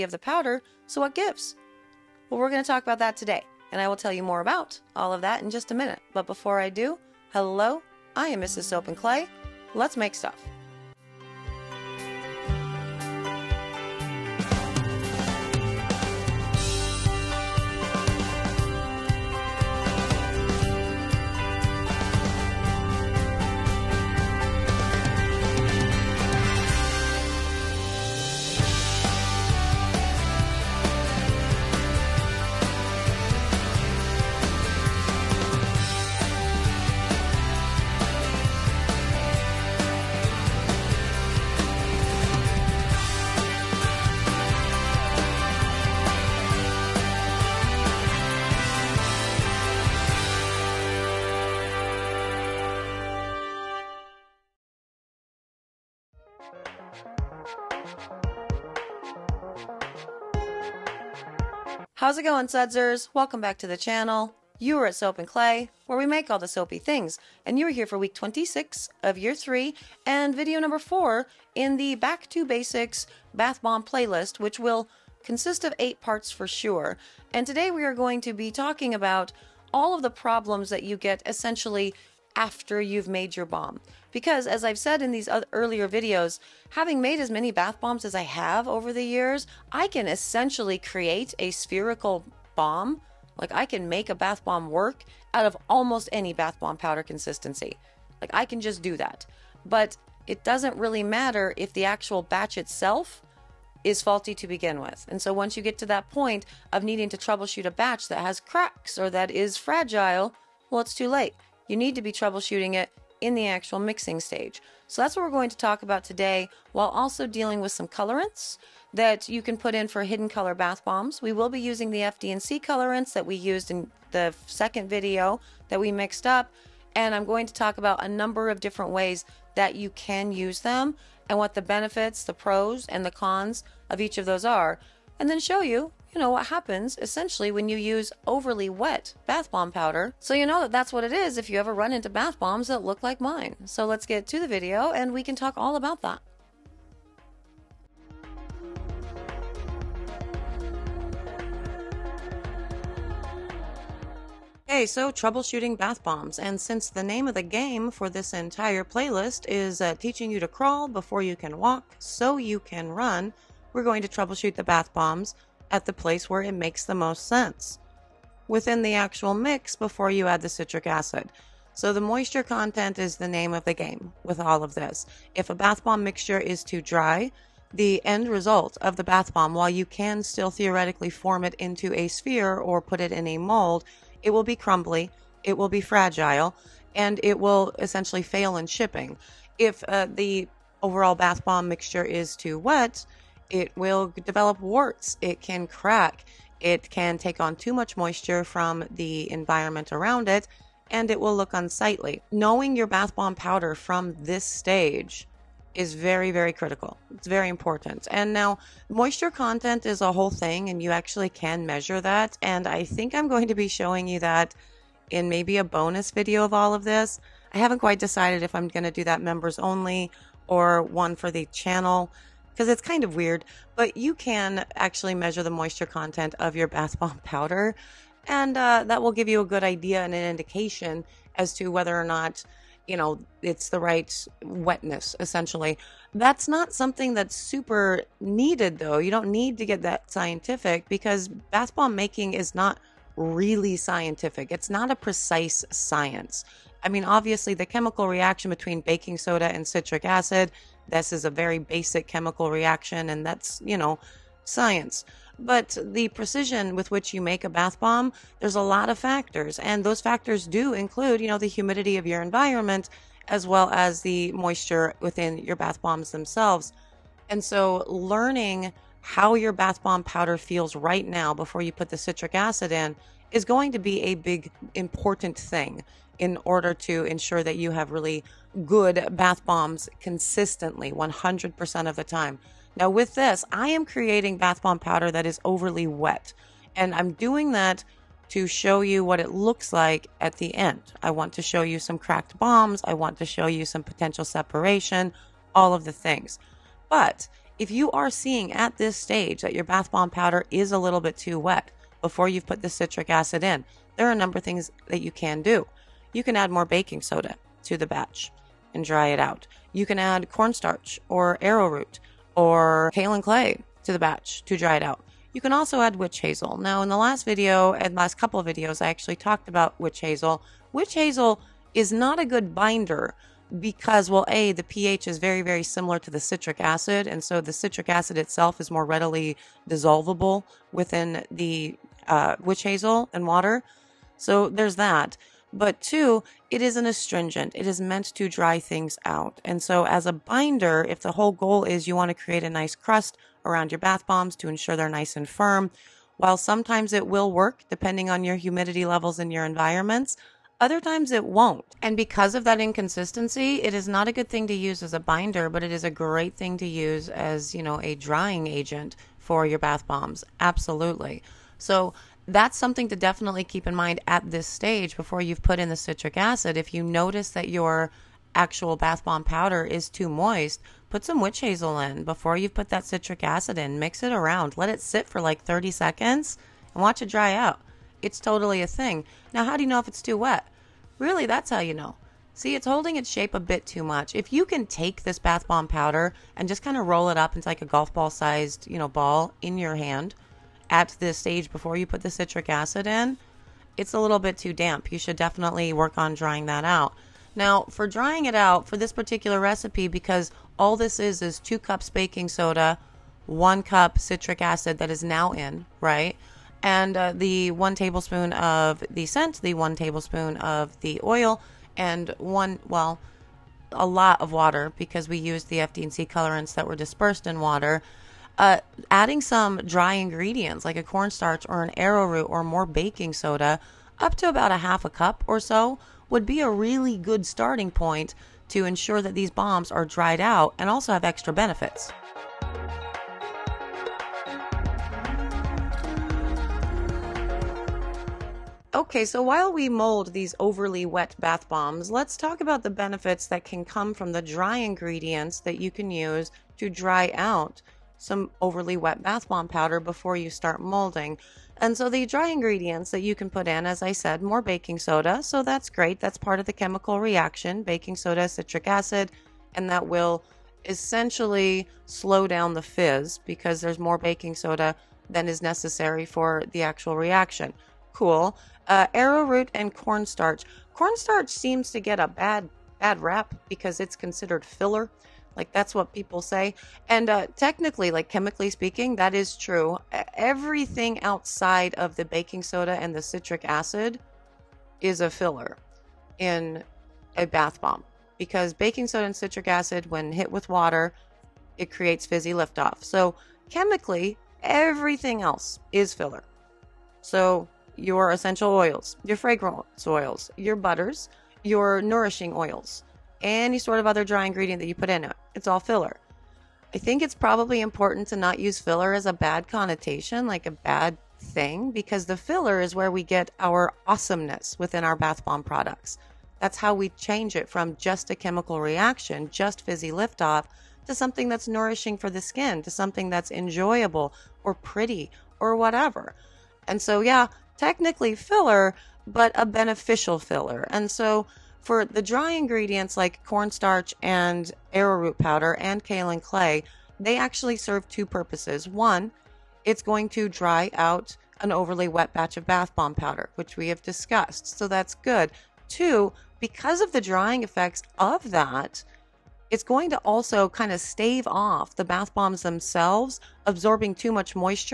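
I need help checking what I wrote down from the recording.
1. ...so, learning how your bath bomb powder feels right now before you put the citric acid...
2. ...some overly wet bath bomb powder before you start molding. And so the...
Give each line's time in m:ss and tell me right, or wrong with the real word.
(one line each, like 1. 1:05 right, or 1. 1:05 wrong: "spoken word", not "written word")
1. 4:27 right
2. 7:27 right.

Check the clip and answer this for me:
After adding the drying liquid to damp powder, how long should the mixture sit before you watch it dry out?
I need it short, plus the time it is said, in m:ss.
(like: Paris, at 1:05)
30 seconds, at 6:15.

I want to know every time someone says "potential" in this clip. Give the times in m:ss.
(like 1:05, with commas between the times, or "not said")
4:53.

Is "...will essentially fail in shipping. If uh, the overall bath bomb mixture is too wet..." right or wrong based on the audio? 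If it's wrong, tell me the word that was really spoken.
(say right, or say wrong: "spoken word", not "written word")
right.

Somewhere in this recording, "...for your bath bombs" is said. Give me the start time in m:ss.
5:59.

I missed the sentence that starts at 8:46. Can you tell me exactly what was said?
And so, yeah, technically filler, but a beneficial filler.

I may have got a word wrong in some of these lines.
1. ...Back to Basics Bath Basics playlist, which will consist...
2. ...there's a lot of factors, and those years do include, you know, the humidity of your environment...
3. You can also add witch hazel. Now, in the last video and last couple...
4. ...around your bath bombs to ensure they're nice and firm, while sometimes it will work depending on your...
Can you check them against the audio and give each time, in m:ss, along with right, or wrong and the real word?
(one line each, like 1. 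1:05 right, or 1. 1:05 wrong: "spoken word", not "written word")
1. 1:11 wrong: "Bomb", not "Basics"
2. 4:18 wrong: "factors", not "years"
3. 5:15 right
4. 5:43 right.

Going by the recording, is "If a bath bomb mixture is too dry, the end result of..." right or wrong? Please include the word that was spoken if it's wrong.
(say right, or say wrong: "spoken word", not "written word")
right.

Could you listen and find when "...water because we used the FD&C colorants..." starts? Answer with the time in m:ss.
6:54.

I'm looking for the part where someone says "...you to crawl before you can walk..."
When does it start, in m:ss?
2:40.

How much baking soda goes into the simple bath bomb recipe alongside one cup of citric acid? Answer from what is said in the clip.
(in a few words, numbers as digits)
2 cups.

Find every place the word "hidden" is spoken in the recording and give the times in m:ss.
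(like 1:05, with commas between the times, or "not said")
2:00.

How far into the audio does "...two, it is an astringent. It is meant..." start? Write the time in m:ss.
5:35.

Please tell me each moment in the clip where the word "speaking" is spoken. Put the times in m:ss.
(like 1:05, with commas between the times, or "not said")
7:58.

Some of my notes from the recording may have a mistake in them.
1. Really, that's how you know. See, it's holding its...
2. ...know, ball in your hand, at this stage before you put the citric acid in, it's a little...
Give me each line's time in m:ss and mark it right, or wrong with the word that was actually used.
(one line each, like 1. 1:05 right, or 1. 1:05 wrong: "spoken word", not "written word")
1. 6:20 right
2. 6:28 right.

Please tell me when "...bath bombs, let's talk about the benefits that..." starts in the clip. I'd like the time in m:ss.
7:21.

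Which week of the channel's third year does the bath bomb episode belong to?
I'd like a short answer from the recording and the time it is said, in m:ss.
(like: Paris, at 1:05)
26, at 1:07.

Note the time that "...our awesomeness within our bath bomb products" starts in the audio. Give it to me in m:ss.
8:33.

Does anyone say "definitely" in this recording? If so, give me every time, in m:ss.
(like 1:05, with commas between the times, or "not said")
6:02, 6:35.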